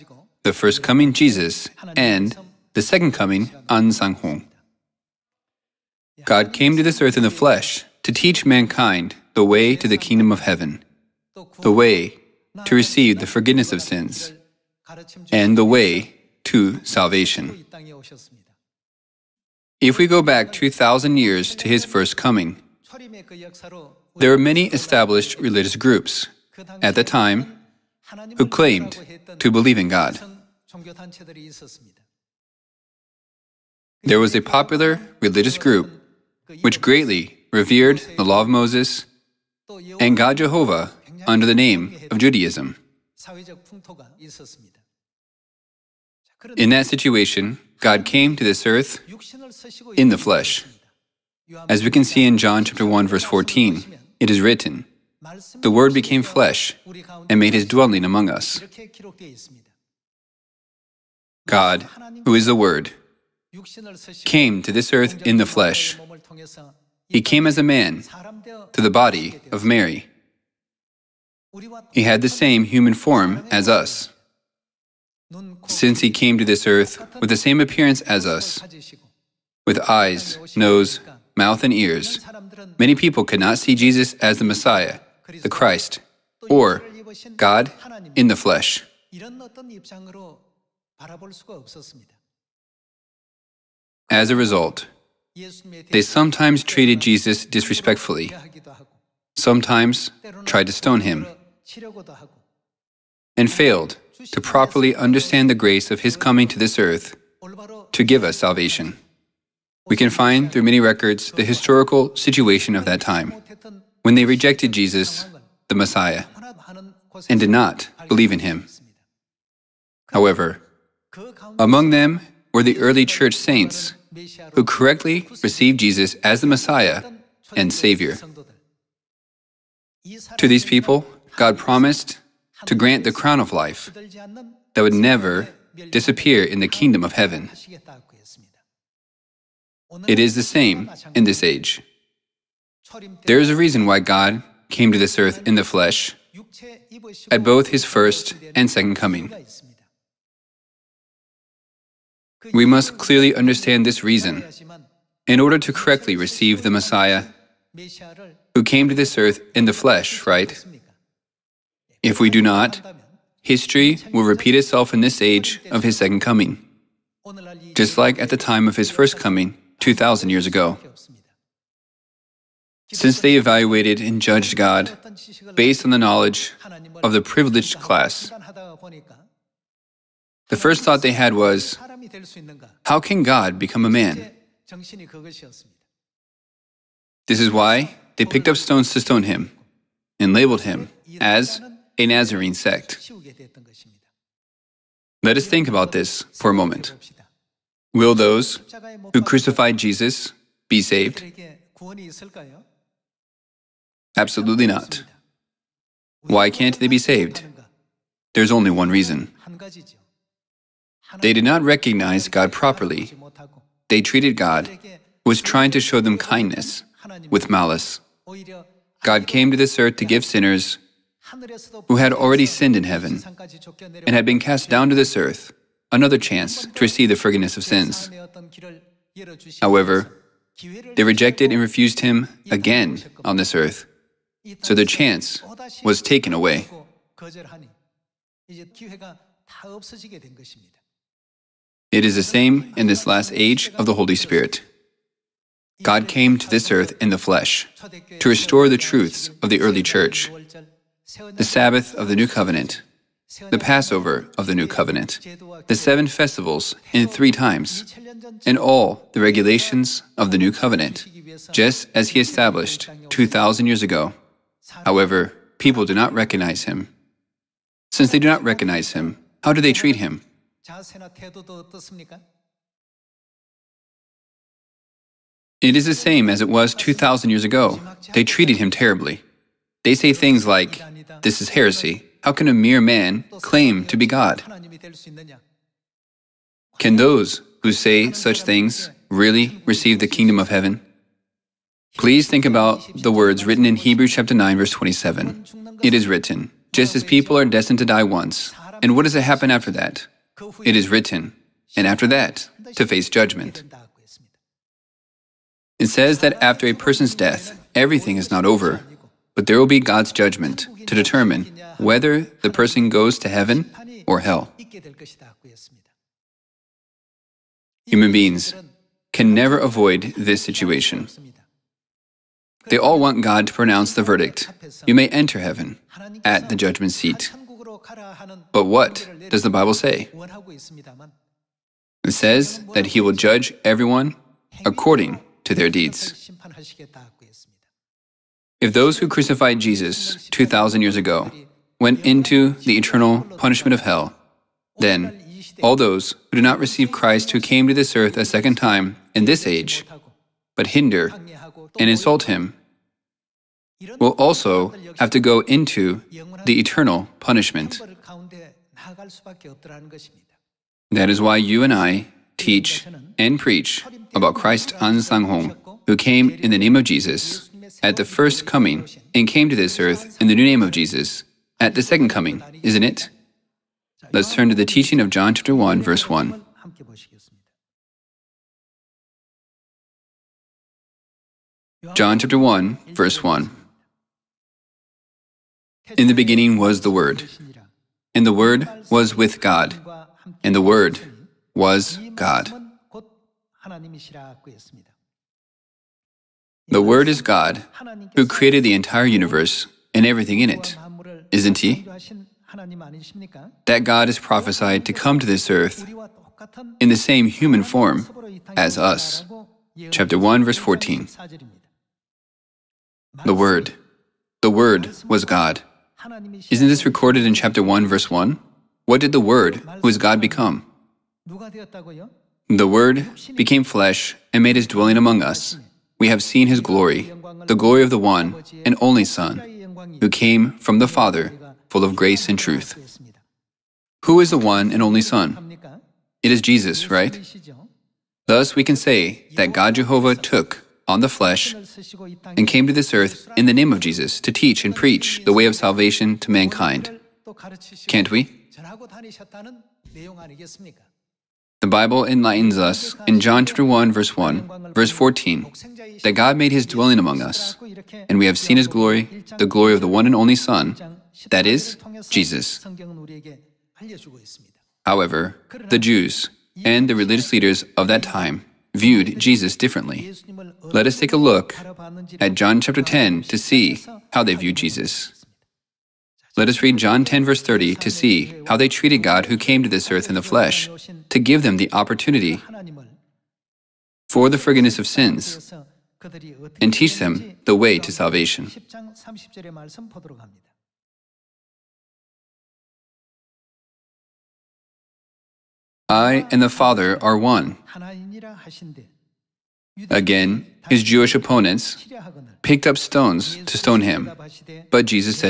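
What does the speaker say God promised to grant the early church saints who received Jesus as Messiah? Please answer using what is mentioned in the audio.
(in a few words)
crown of life.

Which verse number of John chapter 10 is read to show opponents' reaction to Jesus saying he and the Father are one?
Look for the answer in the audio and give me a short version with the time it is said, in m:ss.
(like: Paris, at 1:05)
30, at 7:57.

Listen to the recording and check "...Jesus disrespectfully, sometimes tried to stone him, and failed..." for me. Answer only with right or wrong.
right.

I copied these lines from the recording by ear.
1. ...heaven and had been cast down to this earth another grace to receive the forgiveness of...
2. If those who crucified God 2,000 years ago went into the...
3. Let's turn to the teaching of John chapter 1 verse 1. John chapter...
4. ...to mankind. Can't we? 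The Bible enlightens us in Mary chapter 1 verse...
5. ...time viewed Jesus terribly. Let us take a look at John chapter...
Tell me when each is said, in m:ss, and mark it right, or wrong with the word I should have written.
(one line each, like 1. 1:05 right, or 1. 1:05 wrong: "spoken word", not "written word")
1. 3:42 wrong: "chance", not "grace"
2. 5:38 wrong: "Jesus", not "God"
3. 6:14 right
4. 7:26 wrong: "John", not "Mary"
5. 7:48 wrong: "differently", not "terribly".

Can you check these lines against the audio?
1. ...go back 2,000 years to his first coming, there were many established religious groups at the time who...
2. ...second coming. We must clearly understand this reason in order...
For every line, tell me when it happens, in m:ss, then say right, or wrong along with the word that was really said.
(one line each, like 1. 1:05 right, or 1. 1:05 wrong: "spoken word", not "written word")
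1. 0:20 right
2. 2:28 right.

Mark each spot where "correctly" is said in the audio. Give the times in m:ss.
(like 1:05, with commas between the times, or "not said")
2:04, 2:35.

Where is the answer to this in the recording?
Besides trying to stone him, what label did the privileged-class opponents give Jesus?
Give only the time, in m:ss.
3:12.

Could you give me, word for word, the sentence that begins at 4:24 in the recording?
However, people do not recognize him.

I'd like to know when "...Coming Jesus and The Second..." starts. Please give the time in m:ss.
0:00.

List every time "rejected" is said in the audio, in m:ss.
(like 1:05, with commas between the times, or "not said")
1:54, 3:51.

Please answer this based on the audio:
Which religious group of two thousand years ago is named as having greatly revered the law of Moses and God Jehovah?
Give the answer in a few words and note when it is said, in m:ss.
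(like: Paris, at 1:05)
Judaism, at 0:42.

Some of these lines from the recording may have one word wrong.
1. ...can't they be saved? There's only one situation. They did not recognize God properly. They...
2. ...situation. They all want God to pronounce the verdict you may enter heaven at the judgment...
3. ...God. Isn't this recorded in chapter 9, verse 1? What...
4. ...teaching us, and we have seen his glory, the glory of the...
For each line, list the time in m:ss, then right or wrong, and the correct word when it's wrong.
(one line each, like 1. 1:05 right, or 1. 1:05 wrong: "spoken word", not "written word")
1. 3:26 wrong: "reason", not "situation"
2. 5:20 right
3. 6:55 wrong: "1", not "9"
4. 7:36 wrong: "among", not "teaching".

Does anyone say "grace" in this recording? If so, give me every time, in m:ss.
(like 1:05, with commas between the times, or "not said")
1:45, 7:11.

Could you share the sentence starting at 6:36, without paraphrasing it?
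The Word is God, who created the entire universe and everything in it, isn't He?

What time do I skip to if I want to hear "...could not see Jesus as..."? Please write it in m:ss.
1:23.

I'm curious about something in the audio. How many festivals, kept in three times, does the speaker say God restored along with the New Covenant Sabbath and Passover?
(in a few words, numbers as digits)
7.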